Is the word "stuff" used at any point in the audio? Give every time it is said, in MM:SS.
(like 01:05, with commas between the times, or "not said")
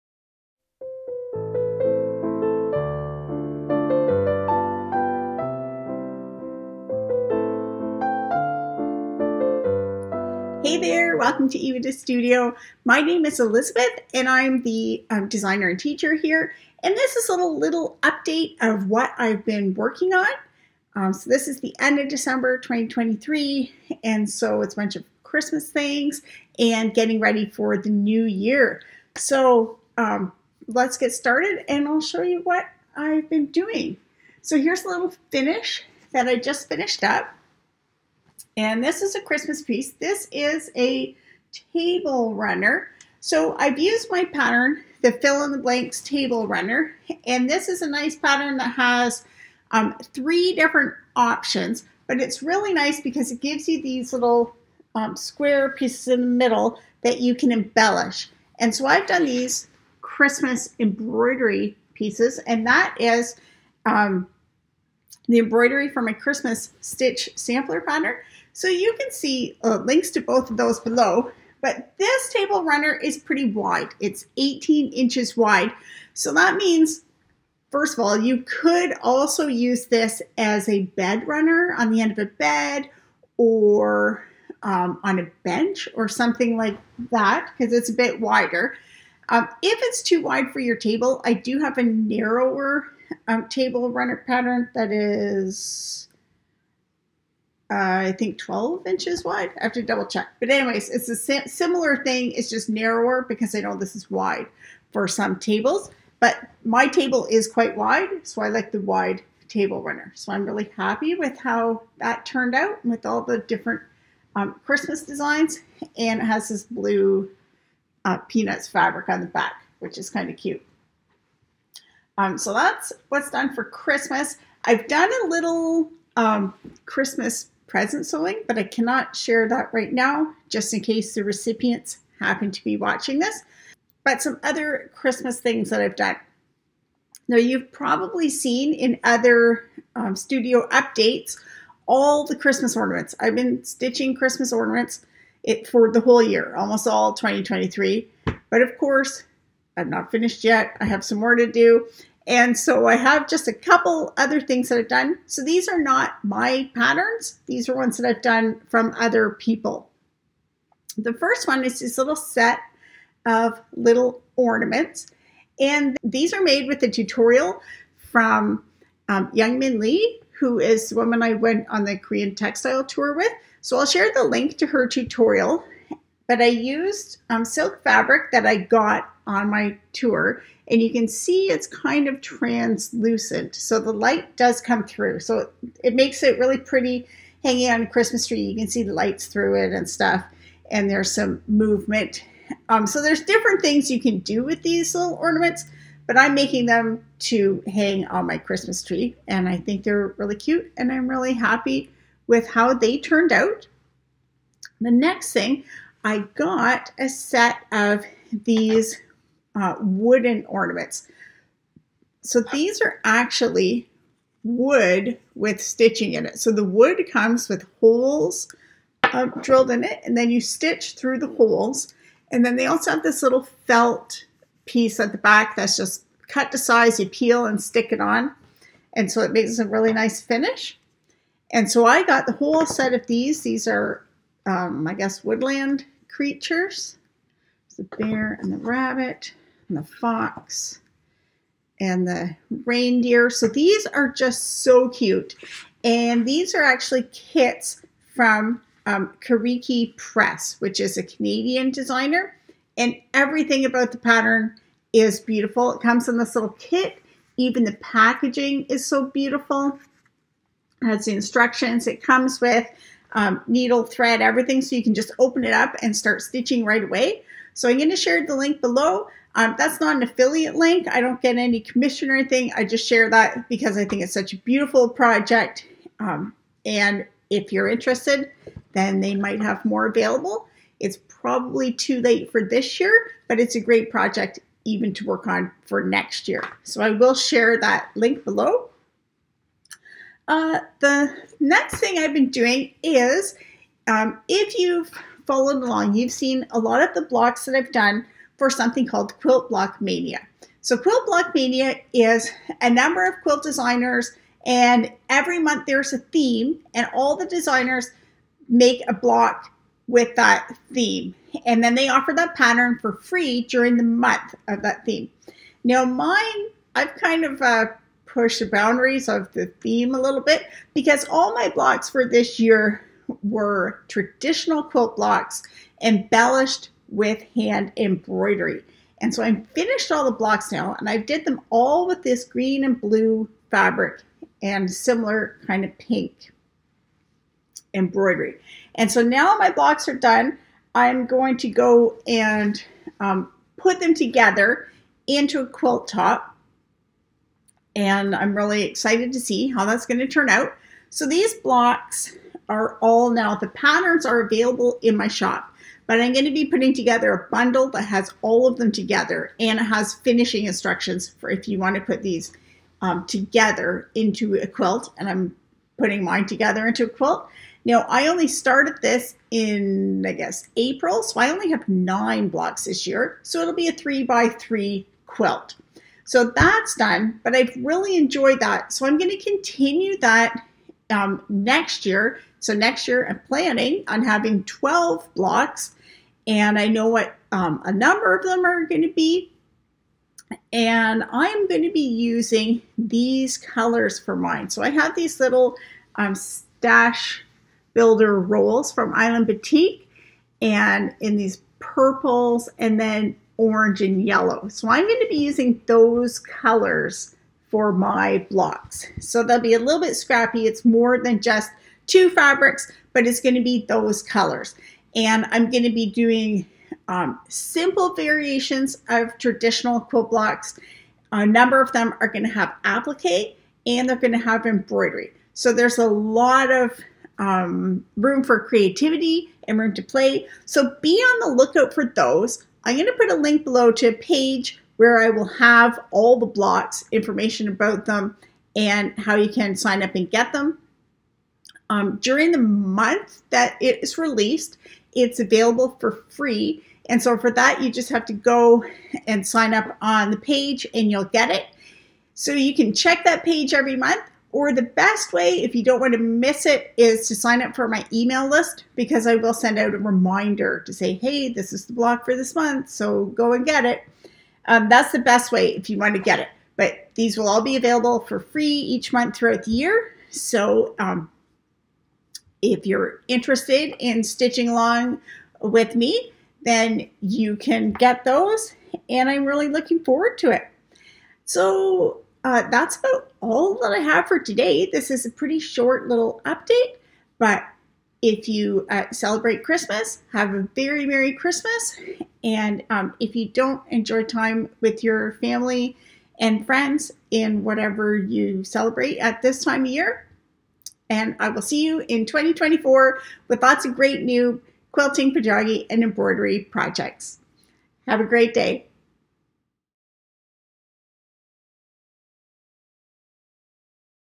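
03:09.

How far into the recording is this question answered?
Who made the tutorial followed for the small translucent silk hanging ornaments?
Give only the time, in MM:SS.
02:49.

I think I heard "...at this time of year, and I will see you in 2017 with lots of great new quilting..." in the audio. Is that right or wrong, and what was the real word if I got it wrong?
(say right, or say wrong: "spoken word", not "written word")
wrong: "2024", not "2017".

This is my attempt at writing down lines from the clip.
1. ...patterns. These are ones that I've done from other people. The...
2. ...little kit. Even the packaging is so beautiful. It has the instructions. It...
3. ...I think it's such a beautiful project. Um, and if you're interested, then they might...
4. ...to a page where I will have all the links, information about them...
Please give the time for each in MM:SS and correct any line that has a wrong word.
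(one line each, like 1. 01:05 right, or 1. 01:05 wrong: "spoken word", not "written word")
1. 02:36 right
2. 04:16 right
3. 04:33 right
4. 07:13 wrong: "blocks", not "links".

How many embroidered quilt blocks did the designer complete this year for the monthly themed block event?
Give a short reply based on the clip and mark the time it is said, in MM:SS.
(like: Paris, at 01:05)
9, at 06:11.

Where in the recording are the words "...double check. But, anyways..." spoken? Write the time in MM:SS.
01:39.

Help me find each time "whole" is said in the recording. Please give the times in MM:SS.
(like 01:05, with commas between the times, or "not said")
02:26, 03:52.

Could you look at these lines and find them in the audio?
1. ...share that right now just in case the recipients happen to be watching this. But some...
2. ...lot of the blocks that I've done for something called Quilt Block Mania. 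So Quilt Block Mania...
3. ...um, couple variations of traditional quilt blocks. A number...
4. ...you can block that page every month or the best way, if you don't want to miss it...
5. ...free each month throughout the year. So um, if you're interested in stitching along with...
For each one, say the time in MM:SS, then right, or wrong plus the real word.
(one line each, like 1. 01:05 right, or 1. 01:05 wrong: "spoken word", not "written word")
1. 02:09 right
2. 04:56 right
3. 06:56 wrong: "simple", not "couple"
4. 07:32 wrong: "check", not "block"
5. 07:48 right.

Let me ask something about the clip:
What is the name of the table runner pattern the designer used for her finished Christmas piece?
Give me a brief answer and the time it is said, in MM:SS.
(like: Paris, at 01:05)
fill in the blanks table runner, at 00:45.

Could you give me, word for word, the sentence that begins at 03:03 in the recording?
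So the light does come through.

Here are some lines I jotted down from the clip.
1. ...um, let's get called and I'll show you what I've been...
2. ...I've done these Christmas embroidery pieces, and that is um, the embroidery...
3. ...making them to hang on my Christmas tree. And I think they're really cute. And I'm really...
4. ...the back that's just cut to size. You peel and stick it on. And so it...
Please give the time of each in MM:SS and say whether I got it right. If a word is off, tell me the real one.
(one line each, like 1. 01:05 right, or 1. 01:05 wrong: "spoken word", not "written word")
1. 00:29 wrong: "started", not "called"
2. 00:58 right
3. 03:16 right
4. 03:45 right.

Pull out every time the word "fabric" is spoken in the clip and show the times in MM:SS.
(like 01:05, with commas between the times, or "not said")
01:58, 02:57, 05:33, 06:52.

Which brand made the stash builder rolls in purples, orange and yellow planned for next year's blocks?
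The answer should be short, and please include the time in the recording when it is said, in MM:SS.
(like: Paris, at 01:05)
Island Batik, at 06:38.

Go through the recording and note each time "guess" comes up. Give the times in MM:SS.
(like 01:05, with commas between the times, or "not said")
03:54, 06:10.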